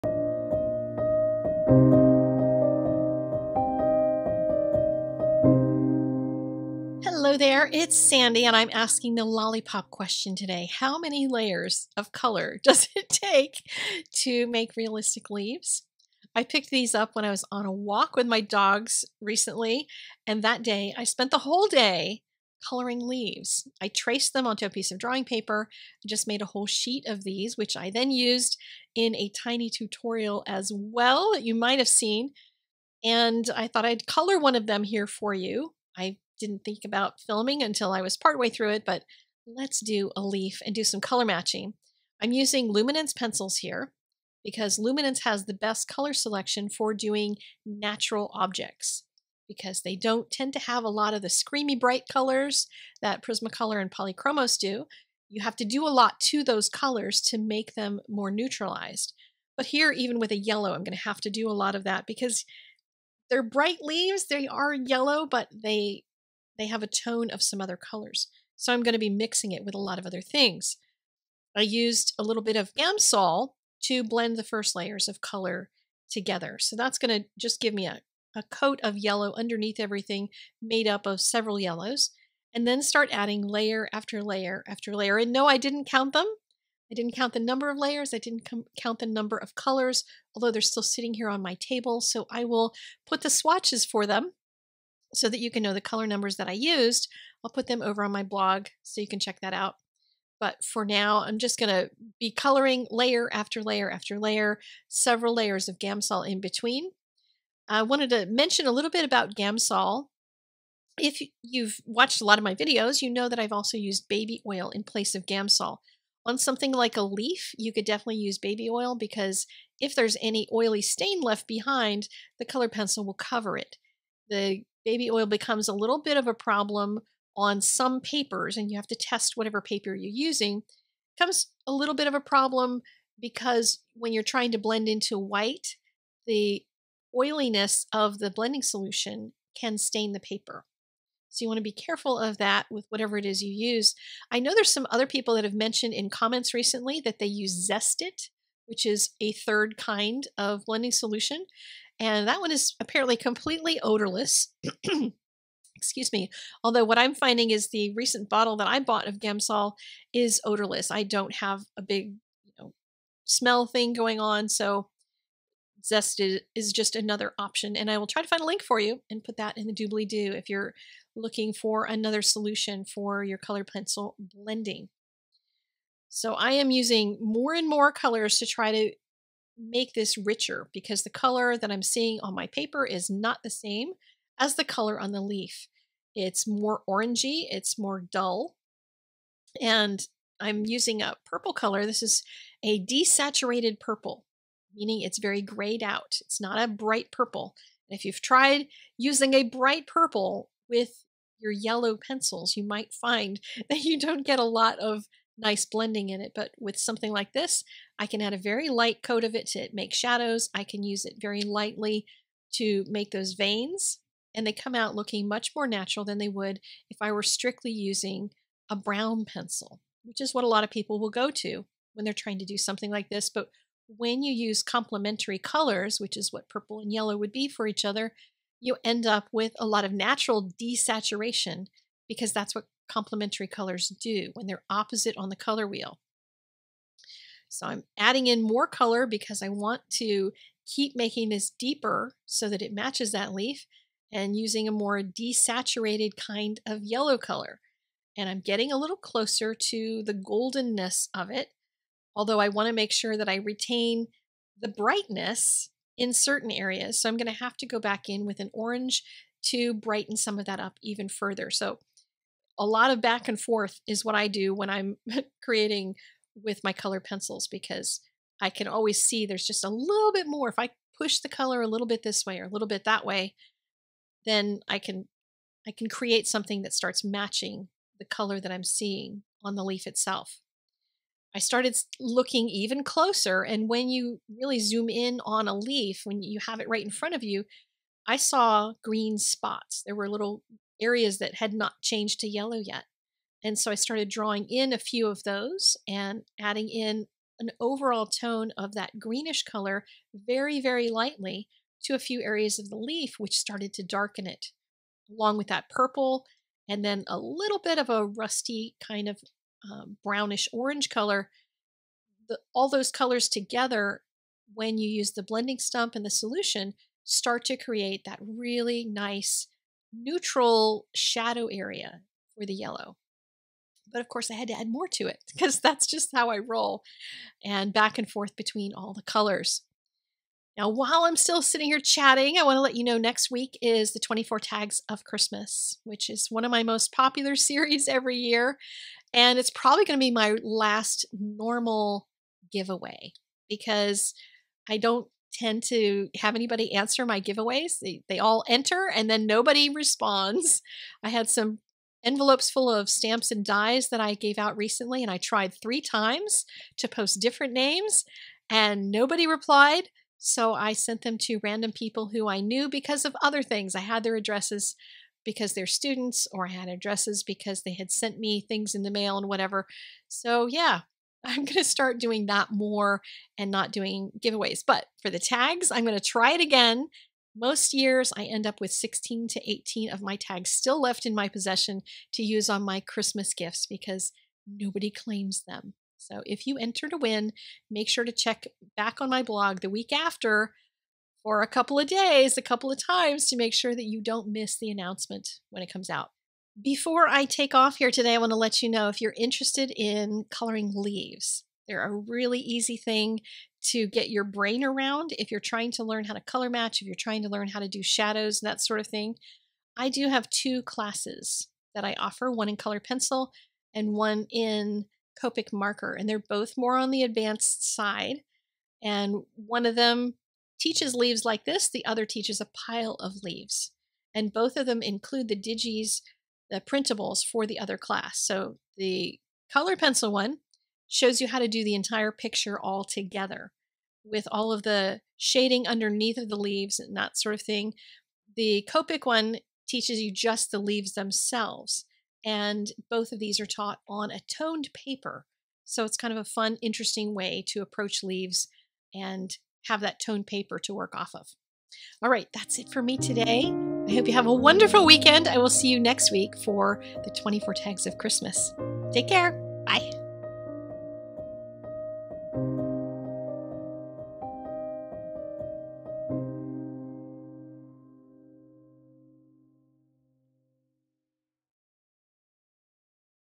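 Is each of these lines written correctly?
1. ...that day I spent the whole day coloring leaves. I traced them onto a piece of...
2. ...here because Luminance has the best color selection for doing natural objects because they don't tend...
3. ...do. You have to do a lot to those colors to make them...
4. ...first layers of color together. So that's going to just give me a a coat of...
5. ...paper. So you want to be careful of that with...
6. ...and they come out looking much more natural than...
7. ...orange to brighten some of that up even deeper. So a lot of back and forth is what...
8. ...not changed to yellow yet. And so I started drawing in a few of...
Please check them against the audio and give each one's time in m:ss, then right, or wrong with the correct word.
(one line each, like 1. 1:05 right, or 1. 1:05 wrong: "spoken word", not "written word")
1. 0:20 right
2. 0:43 right
3. 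0:54 right
4. 1:14 right
5. 2:20 right
6. 3:34 right
7. 4:18 wrong: "further", not "deeper"
8. 4:51 right.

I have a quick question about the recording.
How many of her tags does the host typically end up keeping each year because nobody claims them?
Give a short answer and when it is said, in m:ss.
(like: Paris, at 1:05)
16 to 18, at 6:18.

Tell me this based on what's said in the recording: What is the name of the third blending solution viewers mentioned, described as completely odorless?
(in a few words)
Zest.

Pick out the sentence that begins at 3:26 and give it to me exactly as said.
But with something like this, I can add a very light coat of it to make shadows.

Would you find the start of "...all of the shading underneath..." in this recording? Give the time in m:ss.
7:14.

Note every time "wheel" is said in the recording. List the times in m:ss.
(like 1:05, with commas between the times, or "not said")
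3:55.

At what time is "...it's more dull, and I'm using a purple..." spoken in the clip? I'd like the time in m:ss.
3:07.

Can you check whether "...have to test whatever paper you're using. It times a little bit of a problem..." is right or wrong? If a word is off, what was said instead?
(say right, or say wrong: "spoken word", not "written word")
wrong: "becomes", not "times".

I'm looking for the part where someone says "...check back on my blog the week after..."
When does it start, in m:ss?
6:28.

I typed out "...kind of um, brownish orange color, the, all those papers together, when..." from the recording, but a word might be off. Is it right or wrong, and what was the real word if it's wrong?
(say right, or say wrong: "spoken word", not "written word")
wrong: "colors", not "papers".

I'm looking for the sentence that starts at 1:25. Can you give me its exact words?
And no, I didn't count them.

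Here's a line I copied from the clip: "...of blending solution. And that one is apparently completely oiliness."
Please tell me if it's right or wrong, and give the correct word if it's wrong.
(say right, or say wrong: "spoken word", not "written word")
wrong: "odorless", not "oiliness".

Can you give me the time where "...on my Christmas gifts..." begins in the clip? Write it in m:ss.
6:22.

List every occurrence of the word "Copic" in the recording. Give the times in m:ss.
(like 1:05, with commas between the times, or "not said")
6:55, 7:18.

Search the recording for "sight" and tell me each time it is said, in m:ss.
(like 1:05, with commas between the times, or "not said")
not said.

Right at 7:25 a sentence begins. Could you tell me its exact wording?
So it's kind of a fun, interesting way to approach leaves and have that toned paper to work off of.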